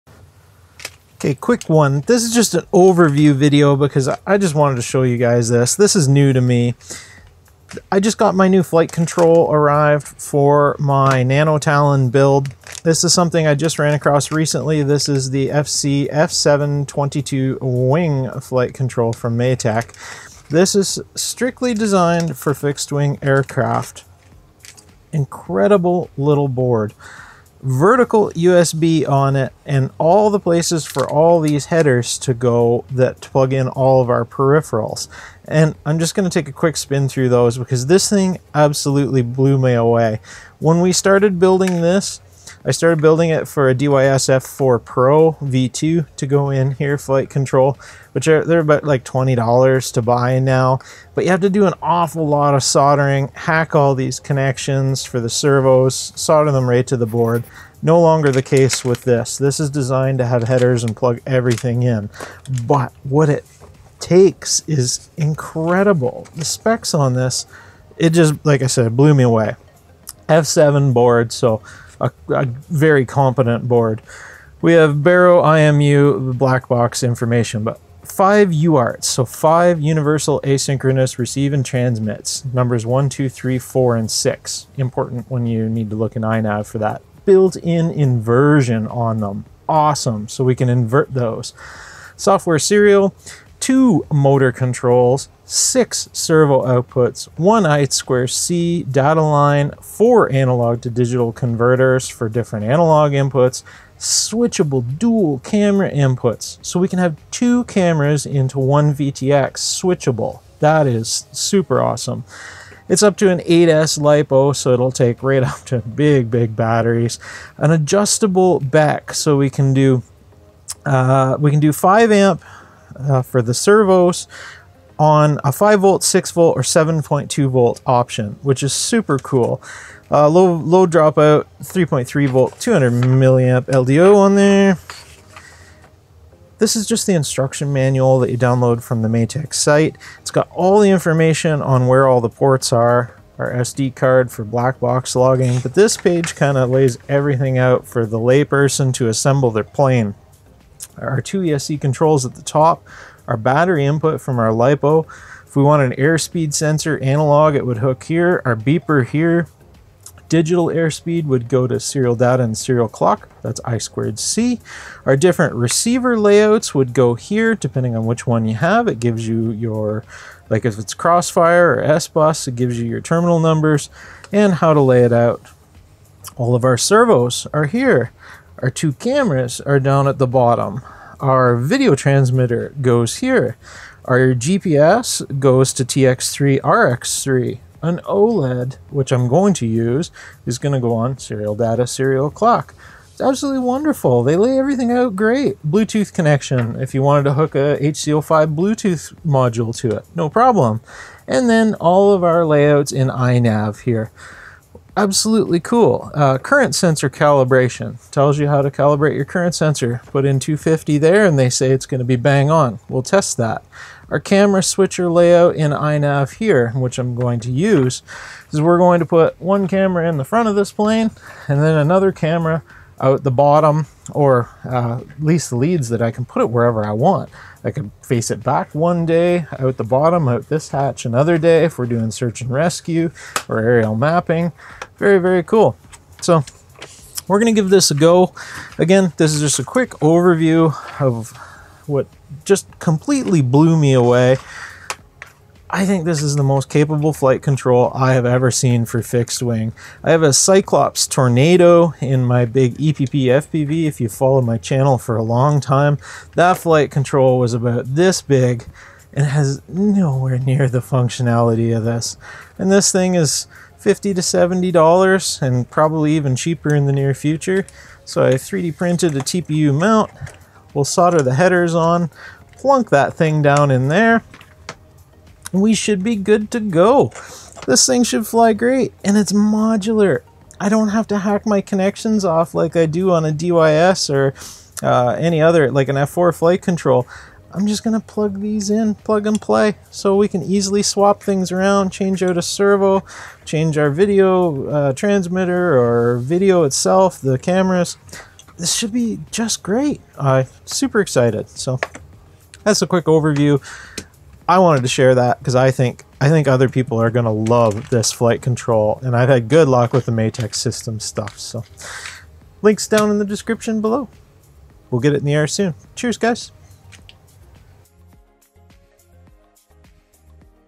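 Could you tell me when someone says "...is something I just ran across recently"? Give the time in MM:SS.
00:13.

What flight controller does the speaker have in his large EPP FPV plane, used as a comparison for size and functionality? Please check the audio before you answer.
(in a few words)
Cyclops Tornado.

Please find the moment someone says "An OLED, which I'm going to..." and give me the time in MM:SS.
03:07.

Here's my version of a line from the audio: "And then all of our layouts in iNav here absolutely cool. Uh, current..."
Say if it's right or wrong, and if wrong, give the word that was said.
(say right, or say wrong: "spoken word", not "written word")
right.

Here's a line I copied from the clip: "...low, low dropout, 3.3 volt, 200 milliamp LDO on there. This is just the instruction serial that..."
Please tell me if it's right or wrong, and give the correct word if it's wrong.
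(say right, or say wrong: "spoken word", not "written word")
wrong: "manual", not "serial".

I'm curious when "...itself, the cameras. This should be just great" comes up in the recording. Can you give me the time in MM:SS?
04:56.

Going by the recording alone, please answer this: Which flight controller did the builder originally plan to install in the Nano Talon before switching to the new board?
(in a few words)
DYSF4 Pro V2.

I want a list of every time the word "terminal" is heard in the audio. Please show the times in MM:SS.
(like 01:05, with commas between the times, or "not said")
02:53.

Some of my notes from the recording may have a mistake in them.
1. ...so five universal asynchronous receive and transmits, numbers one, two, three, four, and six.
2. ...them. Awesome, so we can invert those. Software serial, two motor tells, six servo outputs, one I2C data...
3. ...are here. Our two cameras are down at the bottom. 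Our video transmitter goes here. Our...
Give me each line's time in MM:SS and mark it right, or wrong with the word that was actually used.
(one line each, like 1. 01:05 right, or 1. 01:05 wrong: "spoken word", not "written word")
1. 01:19 right
2. 01:29 wrong: "controls", not "tells"
3. 02:57 right.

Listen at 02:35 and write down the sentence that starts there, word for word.
If we want an airspeed sensor analog, it would hook here, our beeper here.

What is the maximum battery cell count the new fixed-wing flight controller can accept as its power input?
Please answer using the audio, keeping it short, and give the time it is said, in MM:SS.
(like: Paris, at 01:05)
8S, at 01:53.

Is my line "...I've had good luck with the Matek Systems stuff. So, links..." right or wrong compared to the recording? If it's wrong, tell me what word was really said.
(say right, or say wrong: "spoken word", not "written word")
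right.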